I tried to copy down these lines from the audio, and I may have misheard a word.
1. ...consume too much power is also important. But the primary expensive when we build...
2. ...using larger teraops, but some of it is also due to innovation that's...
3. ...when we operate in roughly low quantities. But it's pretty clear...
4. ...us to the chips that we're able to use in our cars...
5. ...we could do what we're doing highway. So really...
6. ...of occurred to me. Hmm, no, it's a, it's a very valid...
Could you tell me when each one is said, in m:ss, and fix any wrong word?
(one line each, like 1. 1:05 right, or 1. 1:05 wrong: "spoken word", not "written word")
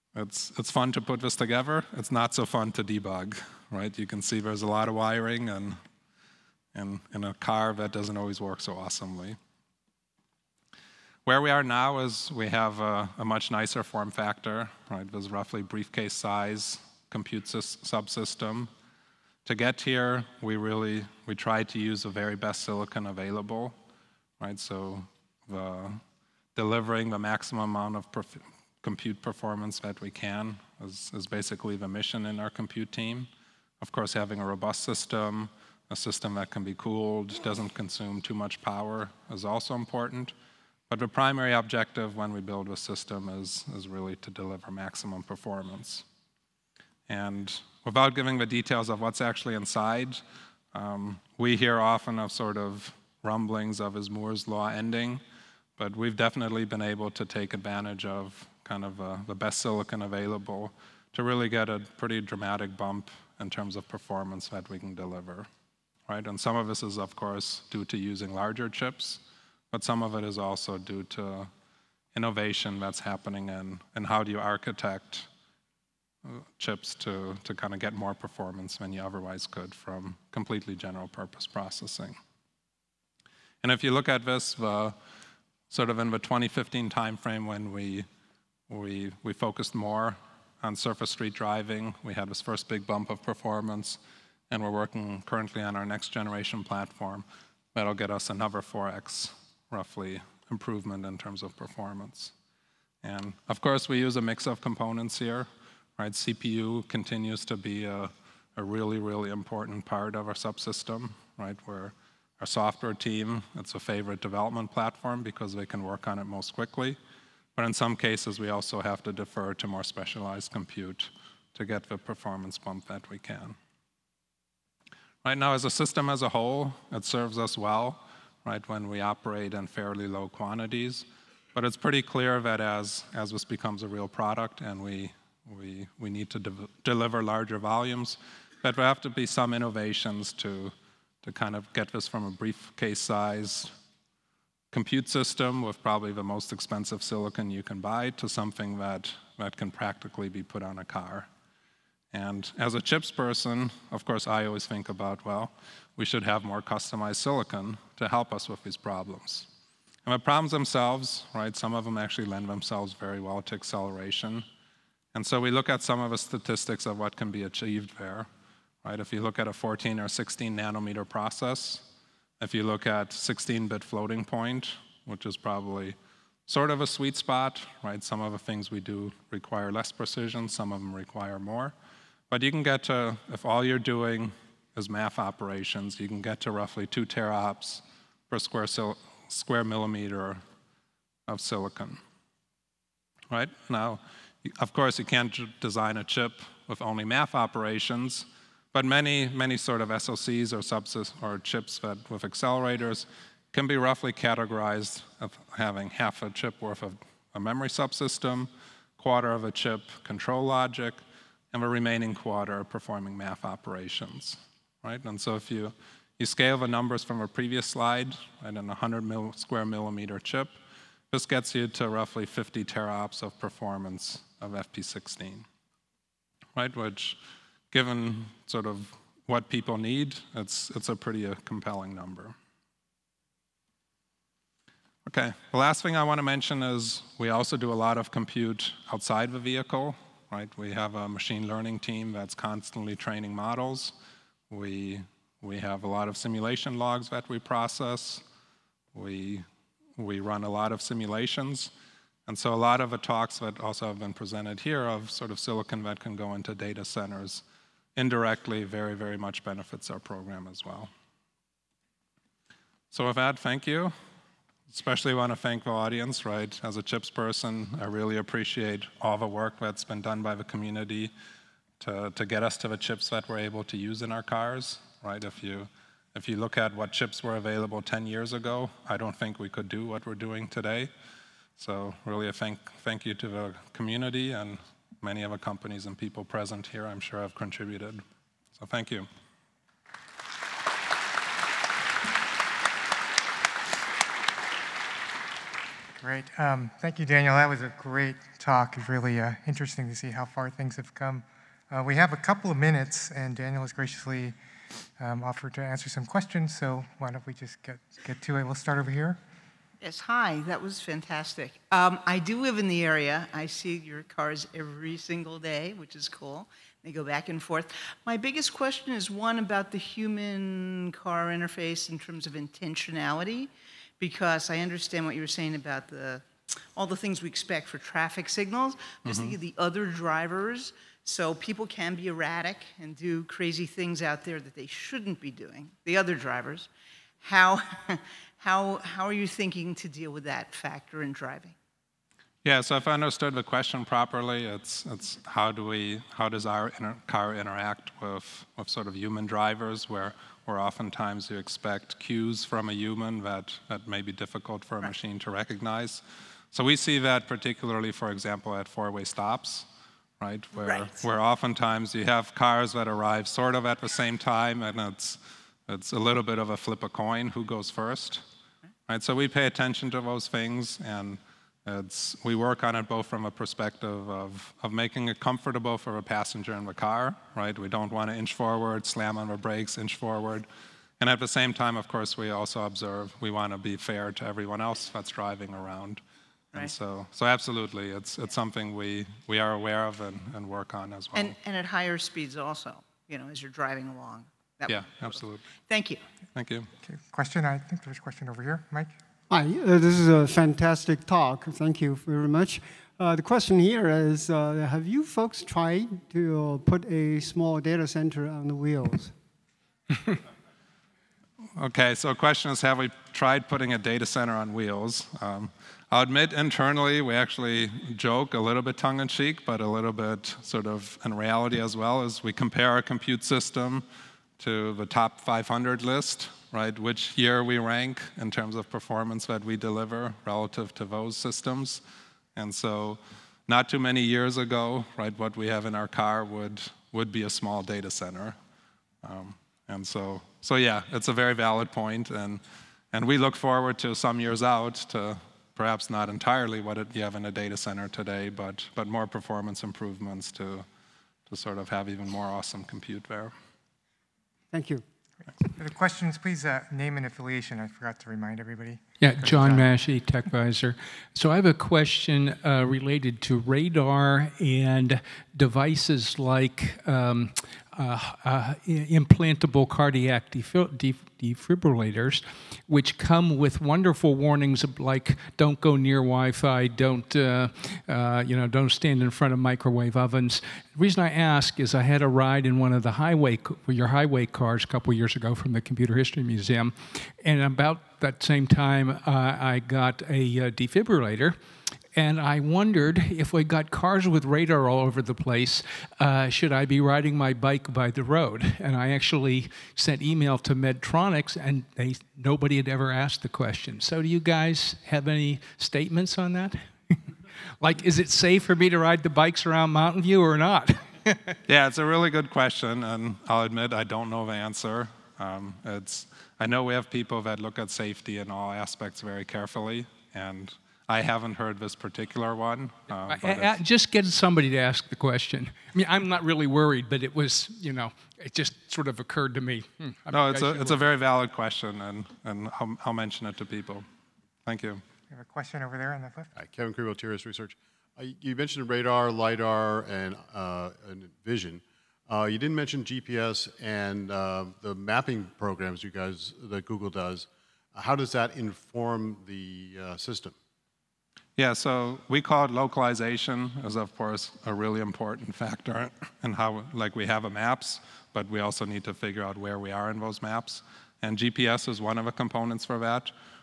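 1. 0:37 wrong: "objective", not "expensive"
2. 1:07 wrong: "chips", not "teraops"
3. 2:08 wrong: "fairly", not "roughly"
4. 4:32 right
5. 4:39 wrong: "today", not "highway"
6. 8:48 right.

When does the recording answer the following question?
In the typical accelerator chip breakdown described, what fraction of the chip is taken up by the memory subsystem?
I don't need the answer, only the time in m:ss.
3:25.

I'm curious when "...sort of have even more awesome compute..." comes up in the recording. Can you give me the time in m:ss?
7:31.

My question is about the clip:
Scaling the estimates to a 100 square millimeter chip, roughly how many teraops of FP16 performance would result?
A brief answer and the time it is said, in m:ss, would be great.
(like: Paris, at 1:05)
50, at 3:42.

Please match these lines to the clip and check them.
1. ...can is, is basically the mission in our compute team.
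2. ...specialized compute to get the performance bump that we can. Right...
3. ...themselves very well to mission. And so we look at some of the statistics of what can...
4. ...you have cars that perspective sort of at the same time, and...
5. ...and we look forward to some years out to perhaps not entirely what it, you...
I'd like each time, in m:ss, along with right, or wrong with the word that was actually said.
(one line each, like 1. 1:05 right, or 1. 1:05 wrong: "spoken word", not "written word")
1. 0:30 right
2. 1:59 right
3. 2:42 wrong: "acceleration", not "mission"
4. 6:01 wrong: "arrive", not "perspective"
5. 7:22 right.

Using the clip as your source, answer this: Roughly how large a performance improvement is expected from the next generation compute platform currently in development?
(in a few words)
4x.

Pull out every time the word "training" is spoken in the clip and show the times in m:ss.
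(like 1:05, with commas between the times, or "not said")
4:02.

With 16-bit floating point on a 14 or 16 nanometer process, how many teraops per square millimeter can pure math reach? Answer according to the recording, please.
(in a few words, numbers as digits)
2.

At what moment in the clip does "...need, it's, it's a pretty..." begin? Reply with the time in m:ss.
3:49.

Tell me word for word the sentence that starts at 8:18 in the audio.
And I actually sent email to Medtronics, and they, nobody had ever asked the question.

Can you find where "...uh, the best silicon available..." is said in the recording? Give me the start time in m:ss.
0:58.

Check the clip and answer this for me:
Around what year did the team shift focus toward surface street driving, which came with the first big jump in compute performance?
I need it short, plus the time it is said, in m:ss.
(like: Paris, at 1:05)
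2015, at 1:26.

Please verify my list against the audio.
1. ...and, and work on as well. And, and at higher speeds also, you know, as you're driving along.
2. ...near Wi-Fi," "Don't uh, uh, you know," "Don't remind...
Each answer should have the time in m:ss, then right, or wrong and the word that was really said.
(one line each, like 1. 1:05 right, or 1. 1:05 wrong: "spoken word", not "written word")
1. 6:29 right
2. 7:55 wrong: "stand", not "remind".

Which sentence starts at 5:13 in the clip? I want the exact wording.
I see your cars every single day, which is cool.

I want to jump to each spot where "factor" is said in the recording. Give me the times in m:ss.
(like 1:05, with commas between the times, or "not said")
0:14, 5:40, 9:15.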